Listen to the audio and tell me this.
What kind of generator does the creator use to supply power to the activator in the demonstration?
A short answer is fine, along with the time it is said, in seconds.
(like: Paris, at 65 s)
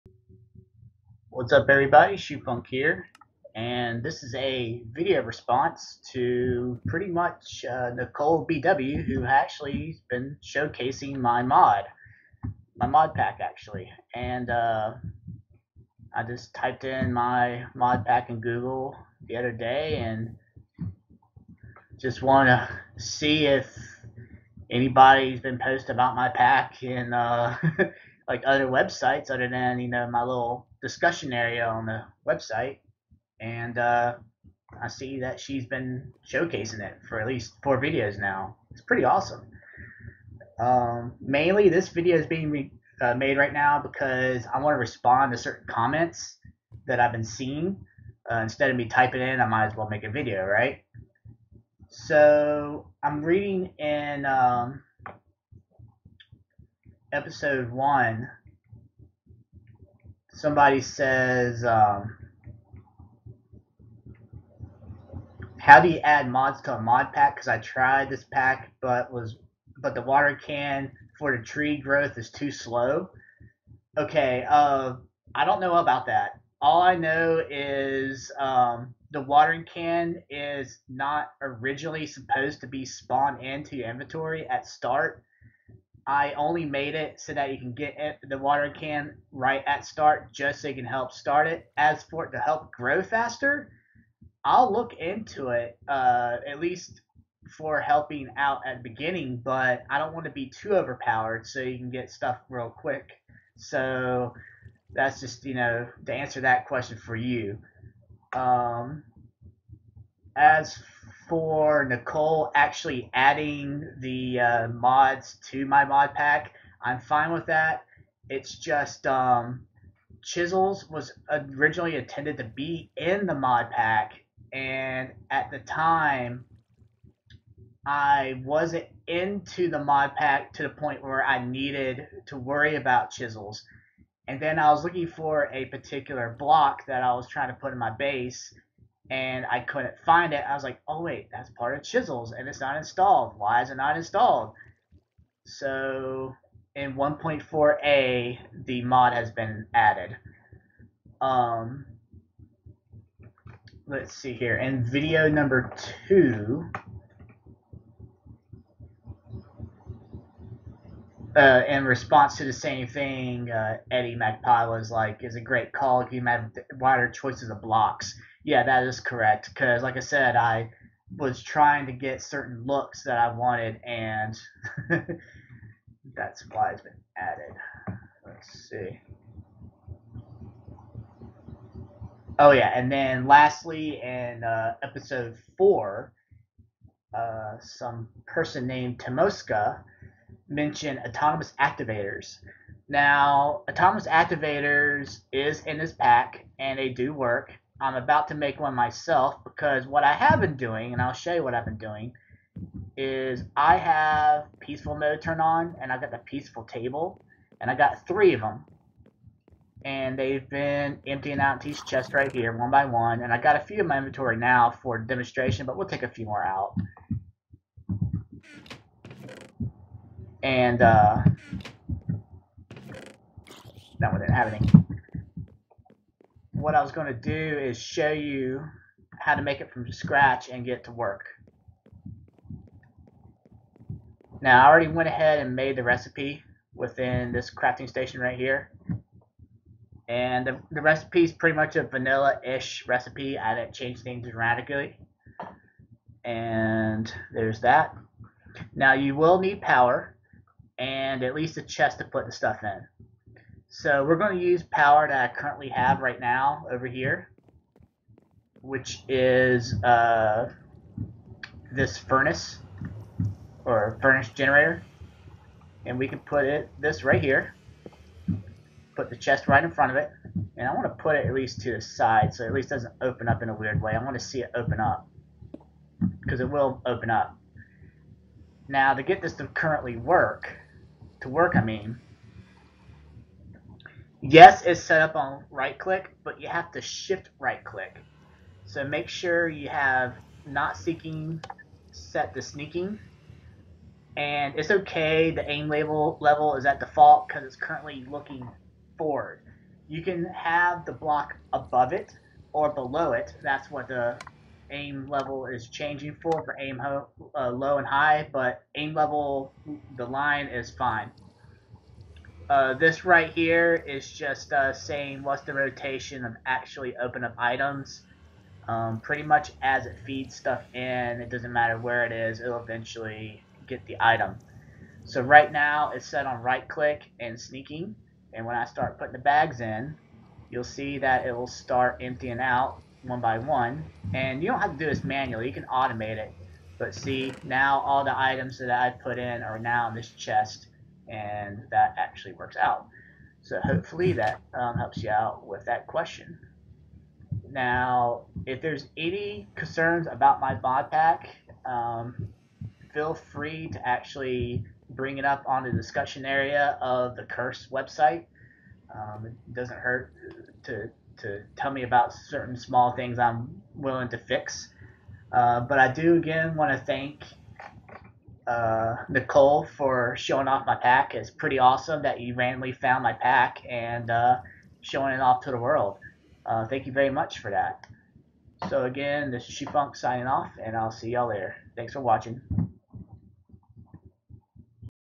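furnace generator, at 264 s.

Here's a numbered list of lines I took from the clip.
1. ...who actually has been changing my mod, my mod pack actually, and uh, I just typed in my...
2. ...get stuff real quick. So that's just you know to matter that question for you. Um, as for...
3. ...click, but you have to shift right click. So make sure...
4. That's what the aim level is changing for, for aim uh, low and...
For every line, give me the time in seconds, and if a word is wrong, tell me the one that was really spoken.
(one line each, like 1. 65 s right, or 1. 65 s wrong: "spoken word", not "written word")
1. 9 s wrong: "showcasing", not "changing"
2. 101 s wrong: "answer", not "matter"
3. 285 s right
4. 303 s right.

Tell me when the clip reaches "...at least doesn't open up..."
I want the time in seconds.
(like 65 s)
272 s.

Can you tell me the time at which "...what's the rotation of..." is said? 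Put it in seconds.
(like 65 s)
315 s.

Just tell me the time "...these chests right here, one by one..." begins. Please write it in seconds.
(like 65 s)
211 s.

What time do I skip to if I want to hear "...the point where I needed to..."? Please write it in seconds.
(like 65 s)
130 s.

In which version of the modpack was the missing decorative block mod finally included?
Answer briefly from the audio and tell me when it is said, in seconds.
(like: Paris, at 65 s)
1.4a, at 146 s.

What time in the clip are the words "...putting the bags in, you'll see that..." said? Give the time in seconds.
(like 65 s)
328 s.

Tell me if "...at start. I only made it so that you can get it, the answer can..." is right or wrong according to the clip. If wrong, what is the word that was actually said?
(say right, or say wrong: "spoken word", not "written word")
wrong: "water", not "answer".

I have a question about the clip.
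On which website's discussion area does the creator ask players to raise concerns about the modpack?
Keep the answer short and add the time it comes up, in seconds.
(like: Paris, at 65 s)
Curse, at 357 s.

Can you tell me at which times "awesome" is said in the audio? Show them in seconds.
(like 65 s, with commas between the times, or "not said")
39 s, 371 s.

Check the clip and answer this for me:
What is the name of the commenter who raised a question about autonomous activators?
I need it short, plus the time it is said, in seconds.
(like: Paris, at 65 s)
Tomoska, at 188 s.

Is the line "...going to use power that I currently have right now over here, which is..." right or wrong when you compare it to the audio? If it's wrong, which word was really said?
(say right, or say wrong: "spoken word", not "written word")
right.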